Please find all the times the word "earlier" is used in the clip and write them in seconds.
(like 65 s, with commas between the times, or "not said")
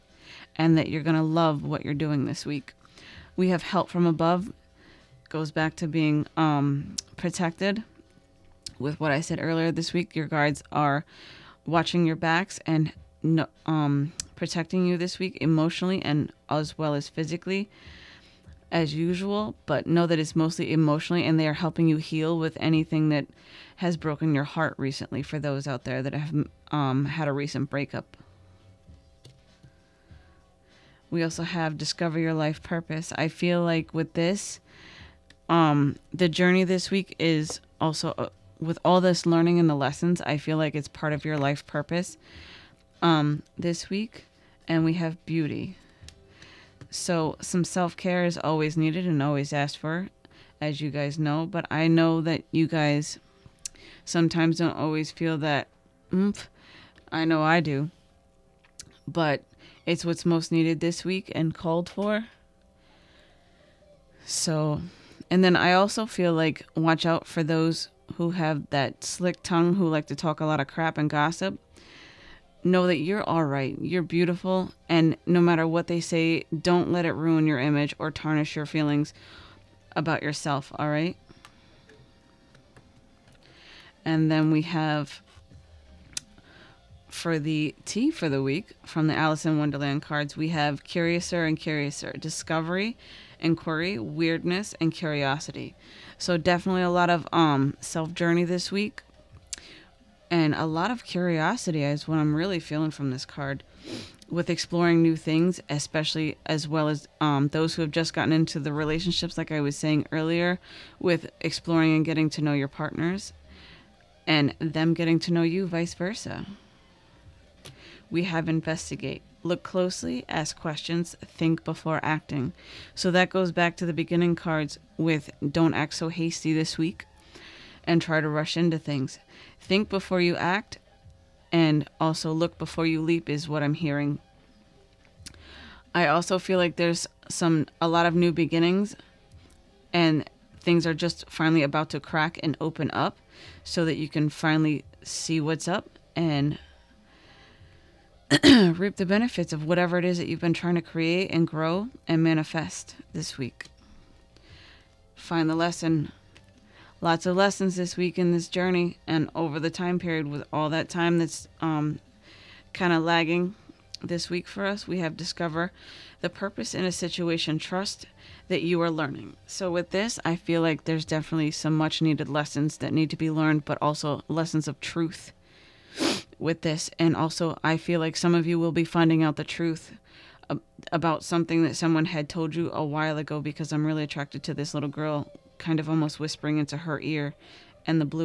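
9 s, 110 s.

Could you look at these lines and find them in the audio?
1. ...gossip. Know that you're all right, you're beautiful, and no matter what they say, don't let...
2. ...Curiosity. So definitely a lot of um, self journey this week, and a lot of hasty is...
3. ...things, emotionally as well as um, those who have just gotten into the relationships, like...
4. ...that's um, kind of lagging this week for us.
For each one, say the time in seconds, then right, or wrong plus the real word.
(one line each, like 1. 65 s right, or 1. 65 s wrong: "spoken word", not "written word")
1. 71 s right
2. 94 s wrong: "curiosity", not "hasty"
3. 105 s wrong: "especially", not "emotionally"
4. 161 s right.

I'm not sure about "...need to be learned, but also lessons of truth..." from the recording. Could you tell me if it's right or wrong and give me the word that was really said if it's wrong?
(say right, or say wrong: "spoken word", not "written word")
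right.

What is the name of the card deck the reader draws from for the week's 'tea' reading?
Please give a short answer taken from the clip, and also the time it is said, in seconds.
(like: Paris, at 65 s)
Alice in Wonderland, at 89 s.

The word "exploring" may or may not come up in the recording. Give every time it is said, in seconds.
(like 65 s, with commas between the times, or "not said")
104 s, 111 s.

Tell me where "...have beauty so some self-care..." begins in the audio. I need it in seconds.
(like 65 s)
44 s.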